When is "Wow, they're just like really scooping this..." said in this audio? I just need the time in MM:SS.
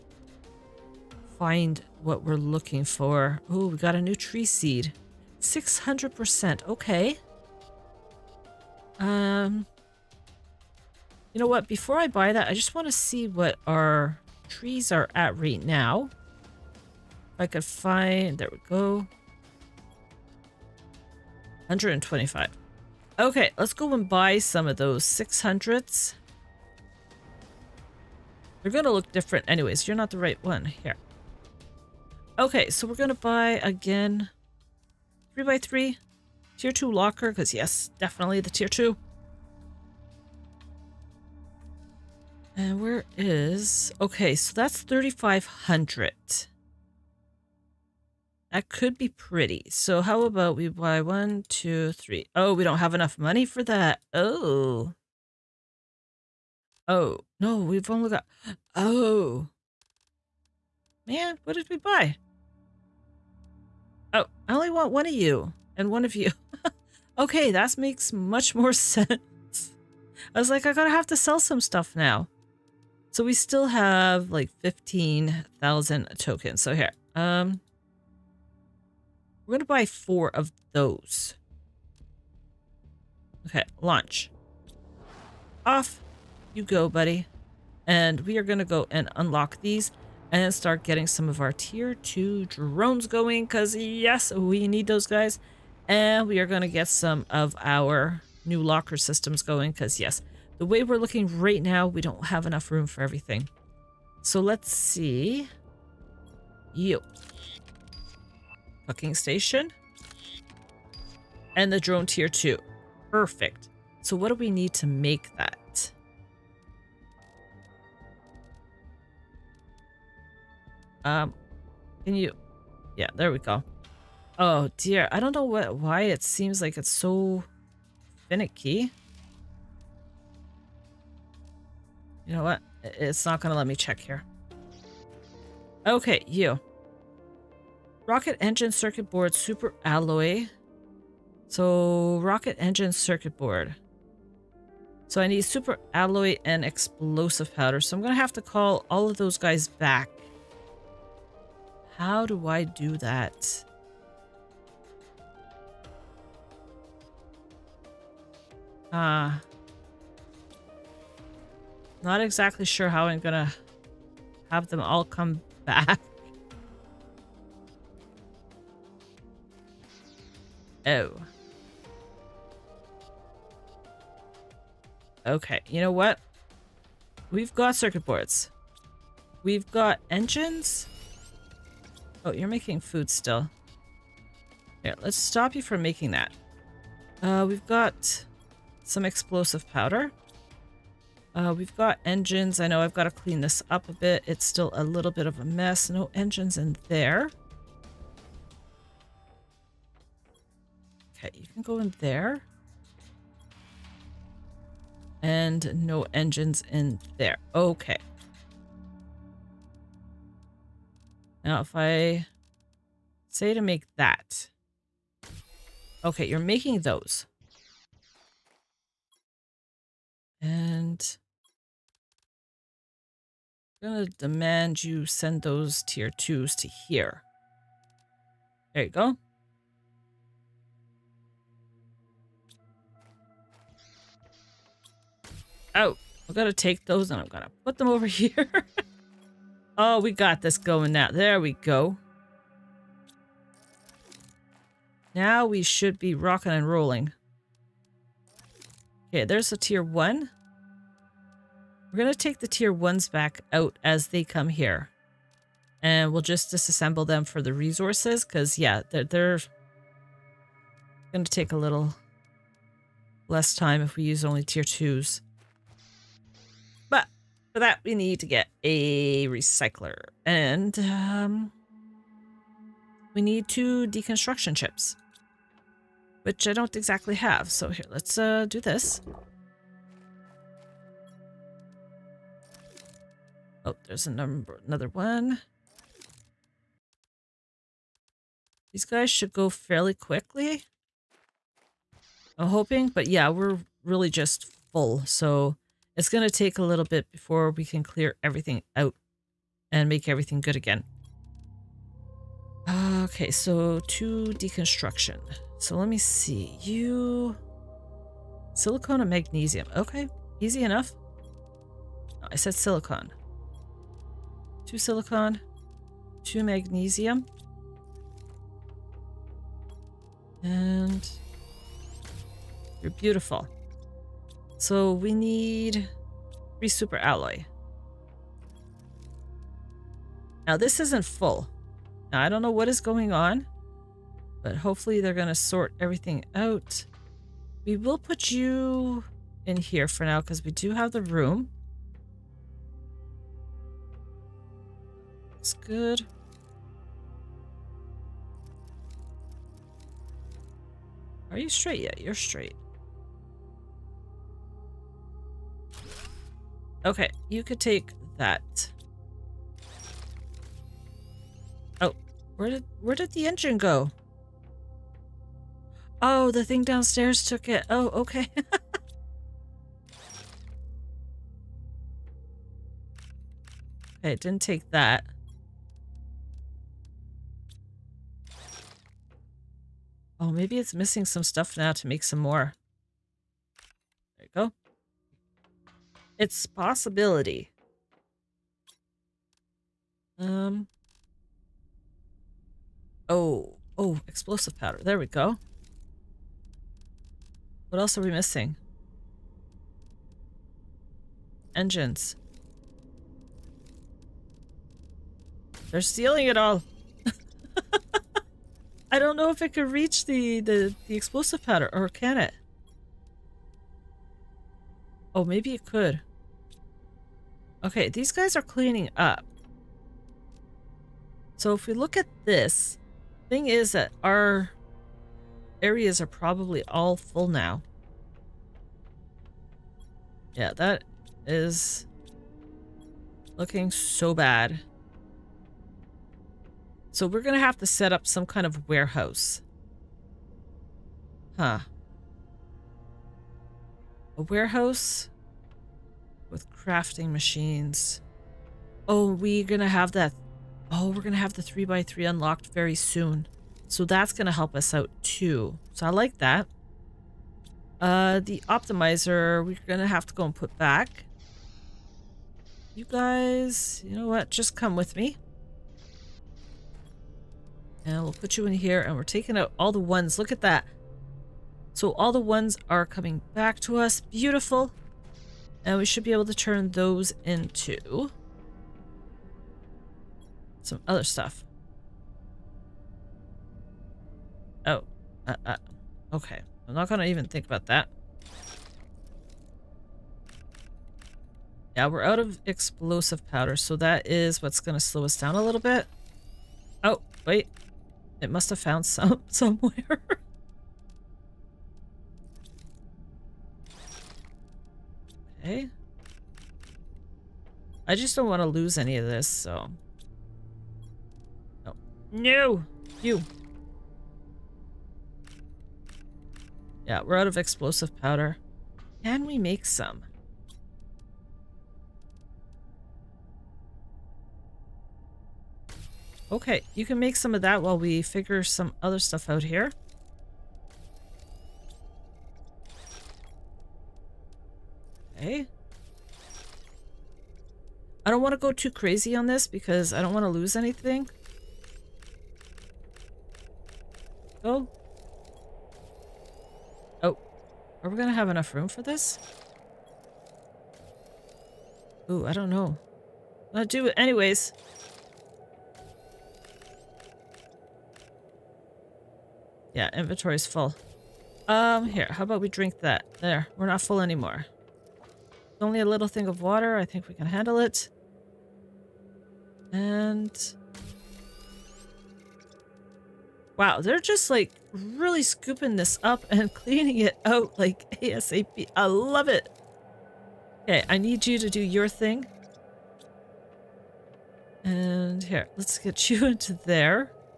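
09:33.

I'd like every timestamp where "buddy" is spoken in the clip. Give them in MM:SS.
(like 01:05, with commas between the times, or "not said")
01:26.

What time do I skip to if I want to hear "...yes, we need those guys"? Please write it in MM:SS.
01:33.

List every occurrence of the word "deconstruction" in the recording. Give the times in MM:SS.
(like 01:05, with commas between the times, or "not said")
04:33, 05:04.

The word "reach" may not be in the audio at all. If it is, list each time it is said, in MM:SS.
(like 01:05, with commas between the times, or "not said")
06:49.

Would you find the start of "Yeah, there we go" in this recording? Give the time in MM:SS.
02:02.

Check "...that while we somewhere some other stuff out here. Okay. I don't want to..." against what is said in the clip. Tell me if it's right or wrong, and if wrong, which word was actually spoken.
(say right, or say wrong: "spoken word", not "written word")
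wrong: "figure", not "somewhere".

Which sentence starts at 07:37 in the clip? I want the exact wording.
Uh, the optimizer, we're gonna have to go and put back.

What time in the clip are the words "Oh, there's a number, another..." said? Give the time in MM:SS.
04:43.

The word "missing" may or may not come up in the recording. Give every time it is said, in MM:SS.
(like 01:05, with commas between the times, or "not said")
06:20, 06:38.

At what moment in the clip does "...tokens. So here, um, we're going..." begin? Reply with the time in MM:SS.
01:16.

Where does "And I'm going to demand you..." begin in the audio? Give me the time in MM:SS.
03:40.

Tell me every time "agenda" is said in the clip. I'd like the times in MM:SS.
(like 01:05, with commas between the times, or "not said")
not said.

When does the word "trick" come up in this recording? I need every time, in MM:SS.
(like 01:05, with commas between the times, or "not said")
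not said.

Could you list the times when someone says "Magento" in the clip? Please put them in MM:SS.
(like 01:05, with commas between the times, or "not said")
not said.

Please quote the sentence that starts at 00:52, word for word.
Oh, we don't have enough money for that.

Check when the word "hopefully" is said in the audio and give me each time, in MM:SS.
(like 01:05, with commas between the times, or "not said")
05:34.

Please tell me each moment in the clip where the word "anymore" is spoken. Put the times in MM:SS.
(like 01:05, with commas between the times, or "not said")
09:24.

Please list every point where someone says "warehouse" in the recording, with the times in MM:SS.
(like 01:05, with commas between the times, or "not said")
07:18, 07:24.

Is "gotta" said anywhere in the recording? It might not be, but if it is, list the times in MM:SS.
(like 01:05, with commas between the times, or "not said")
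01:10.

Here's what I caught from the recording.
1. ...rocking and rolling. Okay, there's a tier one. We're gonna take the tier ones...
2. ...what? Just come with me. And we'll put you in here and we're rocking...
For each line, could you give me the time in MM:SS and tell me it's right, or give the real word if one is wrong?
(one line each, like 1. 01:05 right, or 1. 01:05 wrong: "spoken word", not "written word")
1. 04:06 right
2. 07:44 wrong: "taking", not "rocking".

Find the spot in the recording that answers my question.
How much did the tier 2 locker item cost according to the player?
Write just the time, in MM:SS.
00:44.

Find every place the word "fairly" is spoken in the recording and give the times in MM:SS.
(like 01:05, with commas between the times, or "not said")
04:49.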